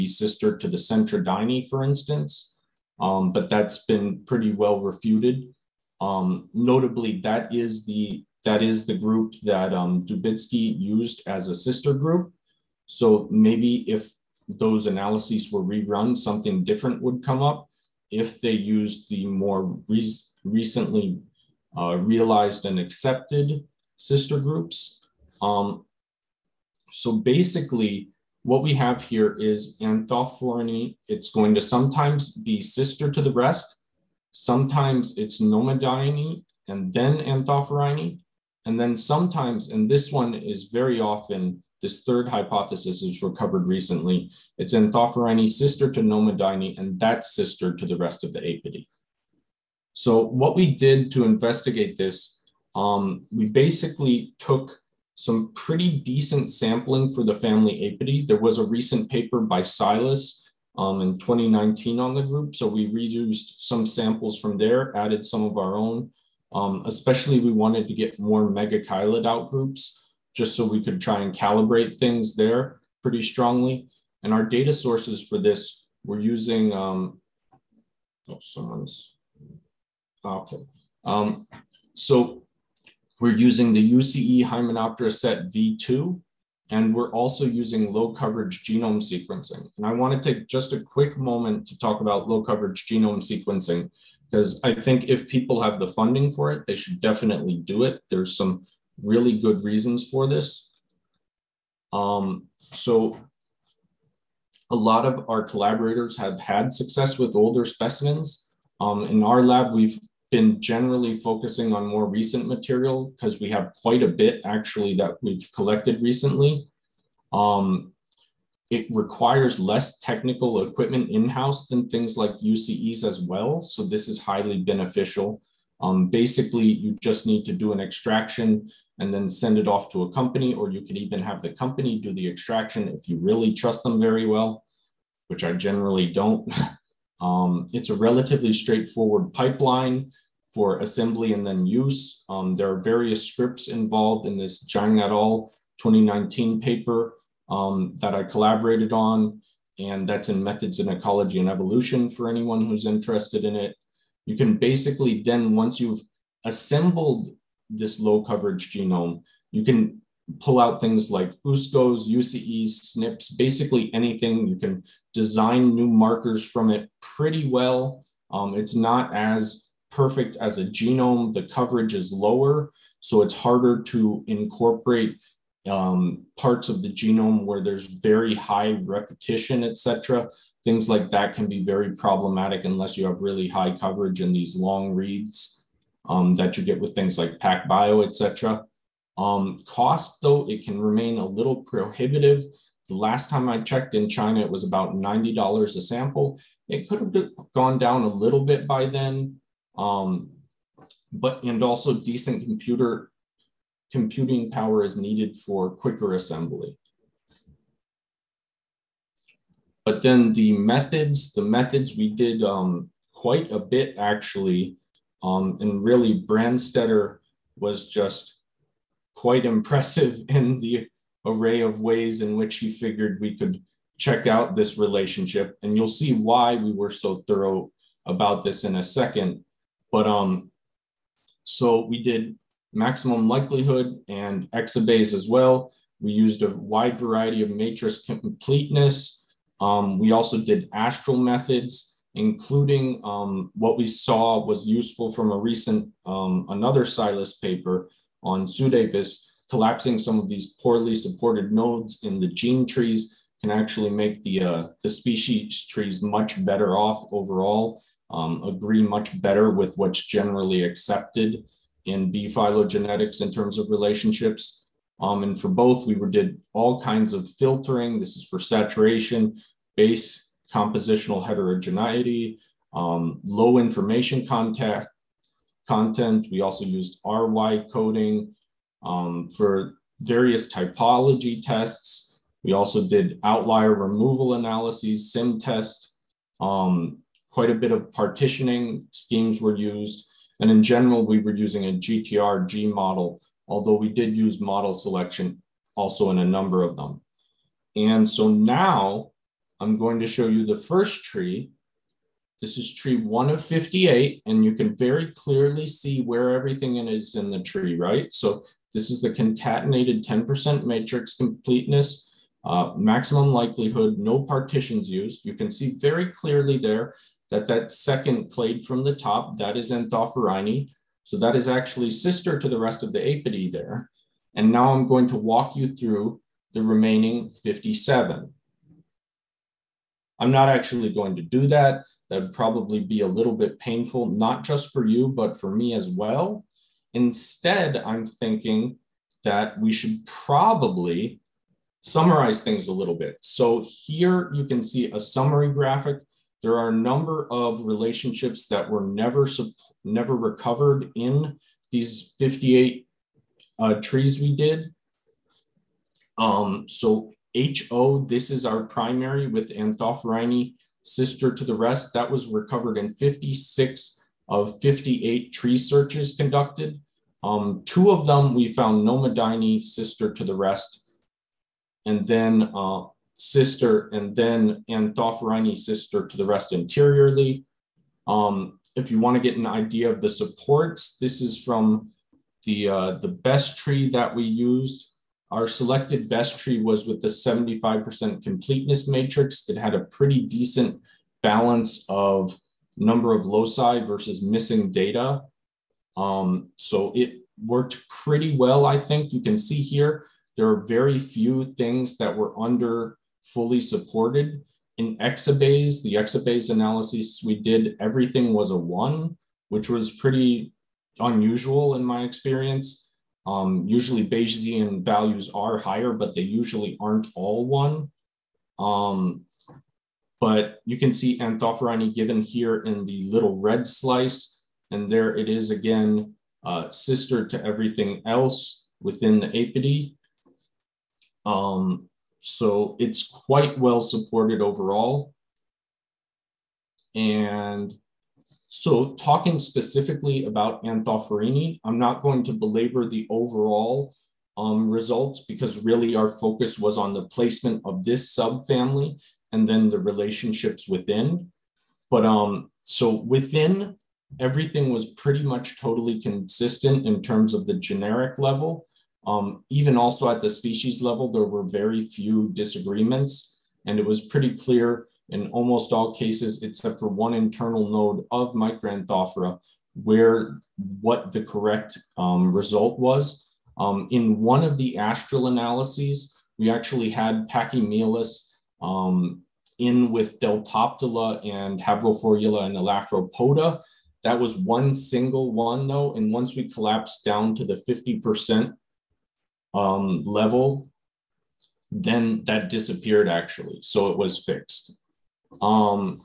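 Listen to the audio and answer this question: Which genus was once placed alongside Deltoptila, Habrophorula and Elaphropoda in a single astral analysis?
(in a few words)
Pachymelus.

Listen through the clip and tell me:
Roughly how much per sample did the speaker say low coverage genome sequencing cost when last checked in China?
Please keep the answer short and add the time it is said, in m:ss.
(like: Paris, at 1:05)
$90, at 3:14.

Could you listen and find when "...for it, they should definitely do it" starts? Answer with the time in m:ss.
1:36.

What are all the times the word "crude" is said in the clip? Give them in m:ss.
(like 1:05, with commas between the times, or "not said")
not said.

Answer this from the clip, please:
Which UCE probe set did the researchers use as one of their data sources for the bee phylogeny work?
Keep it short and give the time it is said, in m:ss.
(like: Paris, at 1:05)
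Hymenoptera set V2, at 1:23.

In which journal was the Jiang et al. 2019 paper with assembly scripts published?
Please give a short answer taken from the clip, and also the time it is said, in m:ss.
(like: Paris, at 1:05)
Methods in Ecology and Evolution, at 2:30.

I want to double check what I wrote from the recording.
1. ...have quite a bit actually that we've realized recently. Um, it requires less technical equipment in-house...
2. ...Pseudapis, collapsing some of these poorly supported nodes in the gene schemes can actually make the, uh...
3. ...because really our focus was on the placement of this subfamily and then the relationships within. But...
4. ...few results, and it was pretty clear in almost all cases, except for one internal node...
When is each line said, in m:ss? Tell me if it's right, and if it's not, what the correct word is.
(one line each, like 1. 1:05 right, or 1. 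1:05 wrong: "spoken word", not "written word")
1. 1:53 wrong: "collected", not "realized"
2. 4:08 wrong: "trees", not "schemes"
3. 7:25 right
4. 7:41 wrong: "disagreements", not "results".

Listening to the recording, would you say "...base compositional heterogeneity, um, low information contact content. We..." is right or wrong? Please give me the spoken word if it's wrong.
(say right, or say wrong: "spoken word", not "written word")
right.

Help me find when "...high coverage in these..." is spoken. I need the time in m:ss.
3:03.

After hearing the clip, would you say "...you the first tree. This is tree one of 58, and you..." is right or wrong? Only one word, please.
right.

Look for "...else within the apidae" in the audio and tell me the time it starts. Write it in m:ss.
7:08.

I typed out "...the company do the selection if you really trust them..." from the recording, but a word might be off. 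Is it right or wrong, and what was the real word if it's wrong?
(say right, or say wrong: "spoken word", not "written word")
wrong: "extraction", not "selection".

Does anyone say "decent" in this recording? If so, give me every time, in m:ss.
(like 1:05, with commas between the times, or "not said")
0:55, 3:21, 6:30.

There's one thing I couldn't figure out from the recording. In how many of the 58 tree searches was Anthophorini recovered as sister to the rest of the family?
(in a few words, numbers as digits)
56.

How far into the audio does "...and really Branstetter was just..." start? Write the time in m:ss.
3:35.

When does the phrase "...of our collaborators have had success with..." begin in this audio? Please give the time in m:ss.
1:45.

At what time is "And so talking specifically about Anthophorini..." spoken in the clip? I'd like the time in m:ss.
7:16.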